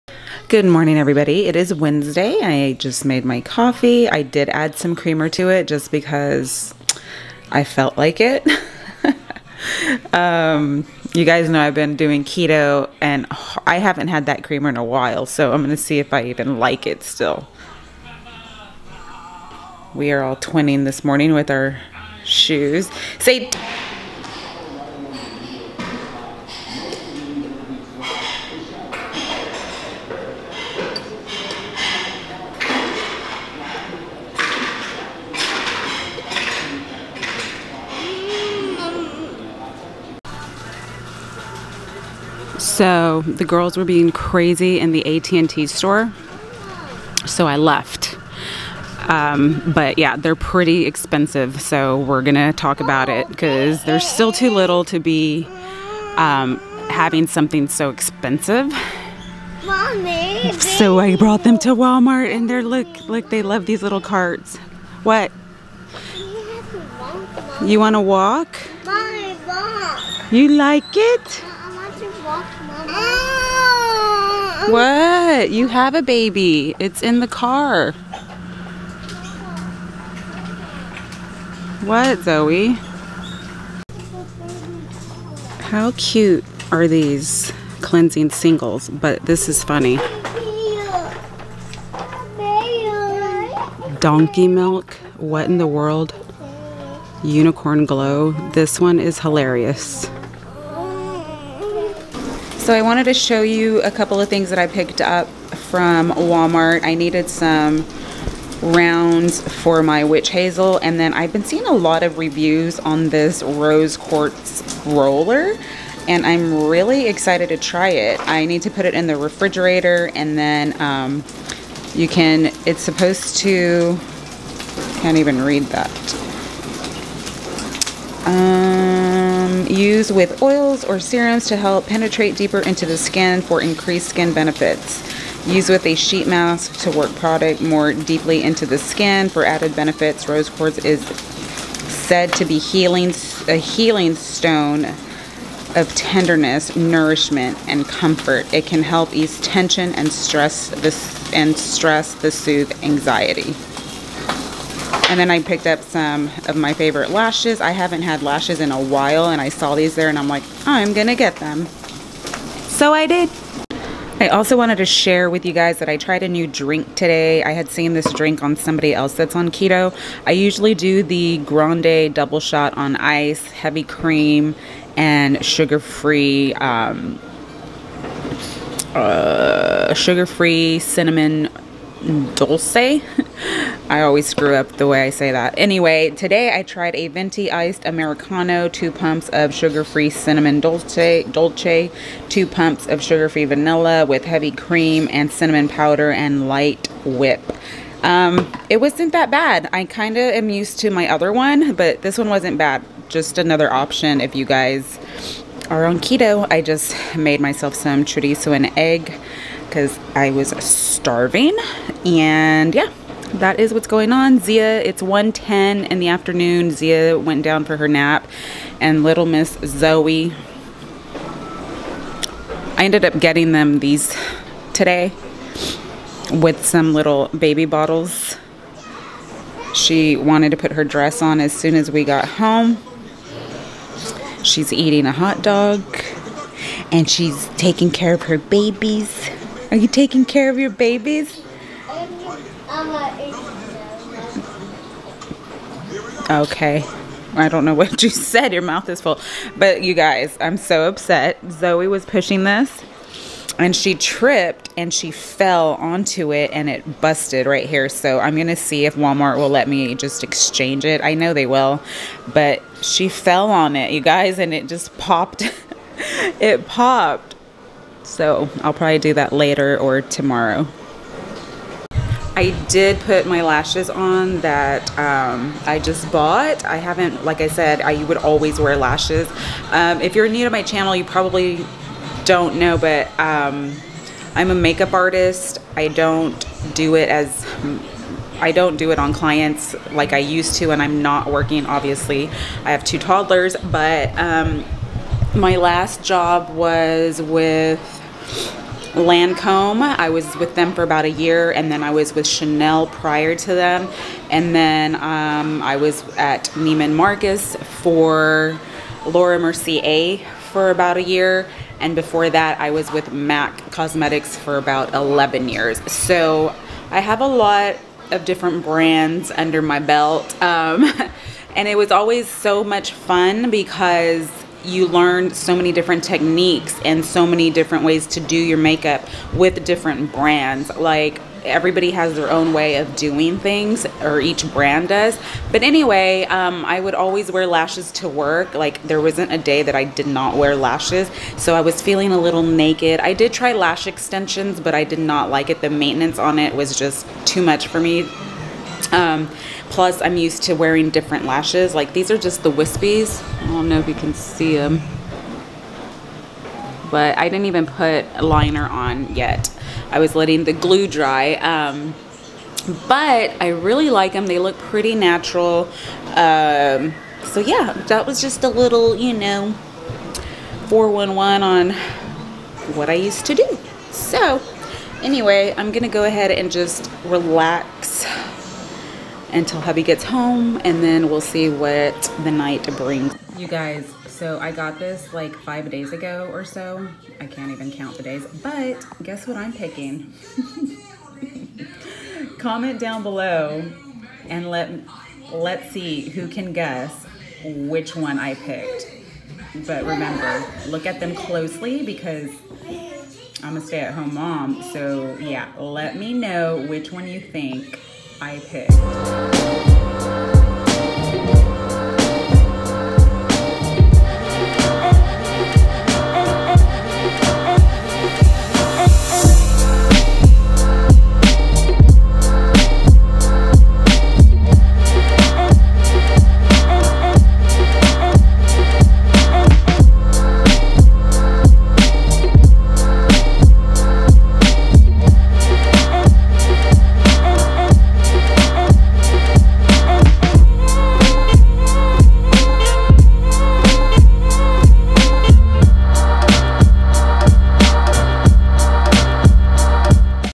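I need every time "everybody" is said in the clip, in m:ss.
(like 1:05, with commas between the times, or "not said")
0:00, 5:31.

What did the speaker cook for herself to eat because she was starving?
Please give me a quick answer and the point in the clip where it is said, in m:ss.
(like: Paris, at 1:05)
Chorizo and egg, at 3:28.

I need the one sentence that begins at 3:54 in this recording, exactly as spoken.
She's eating a hot dog and she's taking care of her babies.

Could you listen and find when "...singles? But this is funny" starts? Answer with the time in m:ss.
1:28.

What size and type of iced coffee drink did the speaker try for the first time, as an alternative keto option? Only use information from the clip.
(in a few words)
Venti iced Americano.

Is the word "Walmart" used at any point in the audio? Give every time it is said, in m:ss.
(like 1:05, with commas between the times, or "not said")
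1:01, 1:46, 4:18.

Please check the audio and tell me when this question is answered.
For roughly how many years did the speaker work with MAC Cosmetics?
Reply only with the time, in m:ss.
5:14.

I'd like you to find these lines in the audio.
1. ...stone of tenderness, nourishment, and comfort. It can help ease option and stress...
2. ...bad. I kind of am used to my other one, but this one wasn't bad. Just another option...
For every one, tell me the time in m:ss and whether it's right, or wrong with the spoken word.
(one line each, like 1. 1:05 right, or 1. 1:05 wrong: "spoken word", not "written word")
1. 2:24 wrong: "tension", not "option"
2. 3:19 right.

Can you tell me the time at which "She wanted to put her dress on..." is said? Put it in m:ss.
3:49.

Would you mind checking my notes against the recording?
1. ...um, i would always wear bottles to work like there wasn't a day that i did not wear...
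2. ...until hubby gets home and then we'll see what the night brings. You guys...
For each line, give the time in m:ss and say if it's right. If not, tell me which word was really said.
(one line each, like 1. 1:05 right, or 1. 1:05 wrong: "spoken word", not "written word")
1. 5:36 wrong: "lashes", not "bottles"
2. 6:19 right.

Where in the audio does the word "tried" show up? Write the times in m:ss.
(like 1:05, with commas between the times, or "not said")
2:45, 3:06.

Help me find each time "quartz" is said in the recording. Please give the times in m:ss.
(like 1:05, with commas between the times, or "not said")
1:53, 2:20.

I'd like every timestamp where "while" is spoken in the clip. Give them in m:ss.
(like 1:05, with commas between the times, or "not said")
0:14, 2:38.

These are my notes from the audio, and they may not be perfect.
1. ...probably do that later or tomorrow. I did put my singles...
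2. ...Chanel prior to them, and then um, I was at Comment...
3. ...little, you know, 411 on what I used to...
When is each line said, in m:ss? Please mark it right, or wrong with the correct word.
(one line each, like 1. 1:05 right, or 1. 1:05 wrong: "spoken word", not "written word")
1. 4:28 wrong: "lashes", not "singles"
2. 5:02 wrong: "Neiman", not "Comment"
3. 6:08 right.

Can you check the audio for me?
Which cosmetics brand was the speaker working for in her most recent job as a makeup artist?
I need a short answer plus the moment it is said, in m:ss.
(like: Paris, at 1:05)
Lancome, at 4:58.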